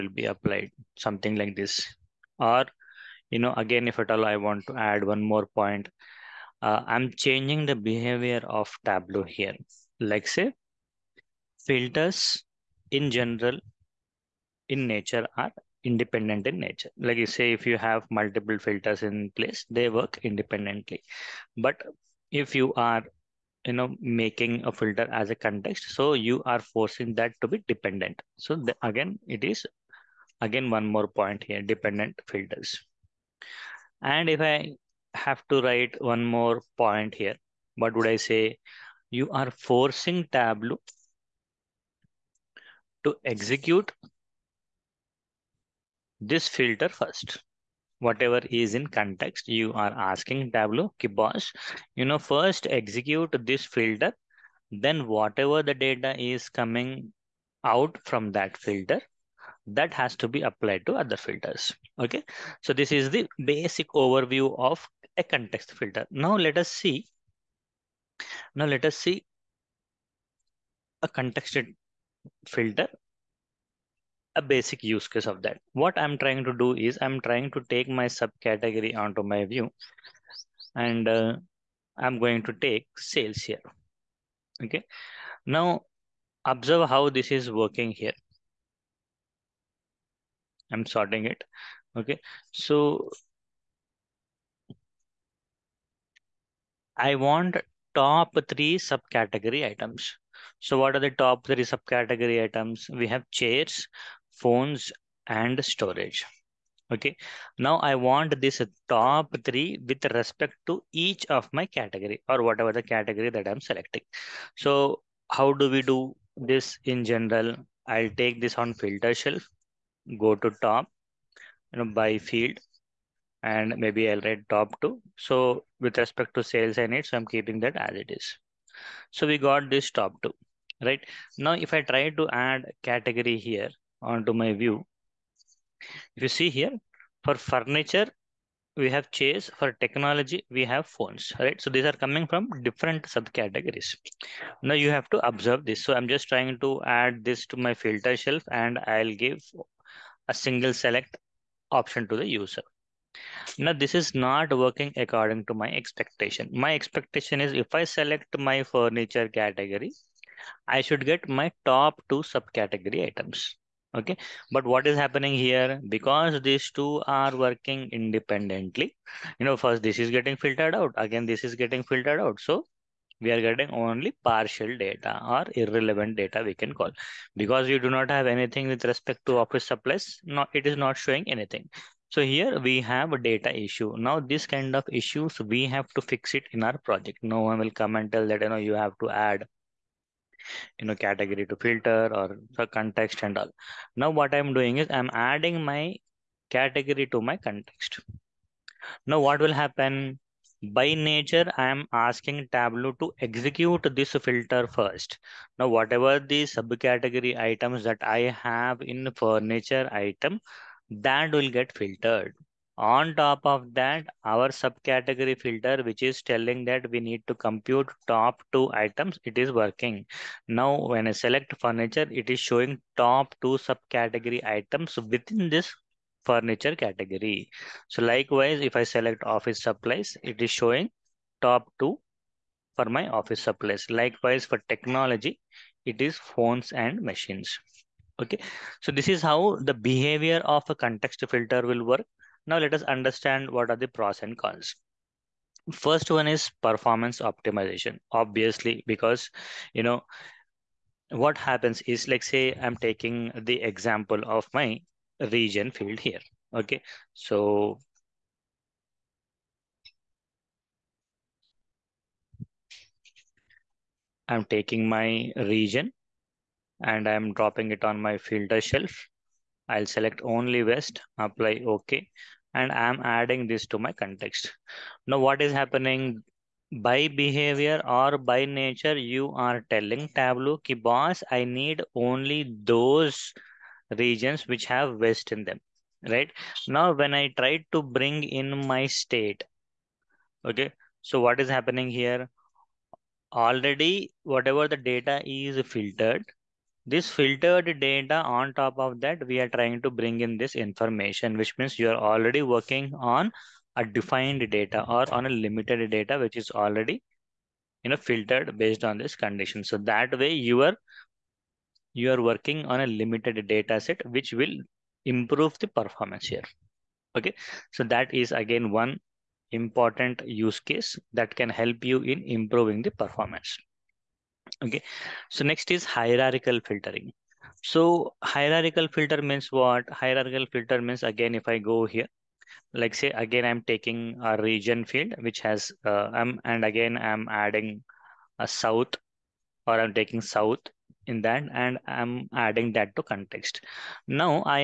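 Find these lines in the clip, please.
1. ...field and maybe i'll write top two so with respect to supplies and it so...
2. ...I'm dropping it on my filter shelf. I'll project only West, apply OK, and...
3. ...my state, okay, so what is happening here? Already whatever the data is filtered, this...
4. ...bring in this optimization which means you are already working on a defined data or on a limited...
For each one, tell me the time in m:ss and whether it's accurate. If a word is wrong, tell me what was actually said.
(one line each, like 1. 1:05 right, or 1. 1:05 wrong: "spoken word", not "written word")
1. 2:02 wrong: "sales", not "supplies"
2. 4:27 wrong: "select", not "project"
3. 4:48 right
4. 4:59 wrong: "information", not "optimization".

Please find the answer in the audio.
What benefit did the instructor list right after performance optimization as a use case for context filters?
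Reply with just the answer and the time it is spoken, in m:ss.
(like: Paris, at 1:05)
Hierarchical filtering, at 5:25.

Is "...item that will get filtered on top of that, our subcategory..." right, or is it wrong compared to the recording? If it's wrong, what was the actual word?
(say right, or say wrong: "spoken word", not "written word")
right.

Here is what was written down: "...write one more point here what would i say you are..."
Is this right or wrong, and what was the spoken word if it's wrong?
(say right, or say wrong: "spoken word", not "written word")
right.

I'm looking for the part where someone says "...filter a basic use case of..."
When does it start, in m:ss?
1:12.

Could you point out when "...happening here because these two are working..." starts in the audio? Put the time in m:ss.
2:44.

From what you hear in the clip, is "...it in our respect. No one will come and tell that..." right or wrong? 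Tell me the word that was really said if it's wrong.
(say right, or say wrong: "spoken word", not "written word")
wrong: "project", not "respect".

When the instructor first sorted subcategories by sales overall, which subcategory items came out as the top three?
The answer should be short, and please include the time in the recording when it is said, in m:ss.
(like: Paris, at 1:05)
Chairs, phones and storage, at 1:43.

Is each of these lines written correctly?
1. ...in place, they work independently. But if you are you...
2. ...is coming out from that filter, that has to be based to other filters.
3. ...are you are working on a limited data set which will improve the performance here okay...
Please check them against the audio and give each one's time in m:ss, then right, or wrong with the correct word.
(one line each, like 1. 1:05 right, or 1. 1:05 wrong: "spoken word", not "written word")
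1. 0:19 right
2. 0:56 wrong: "applied", not "based"
3. 5:10 right.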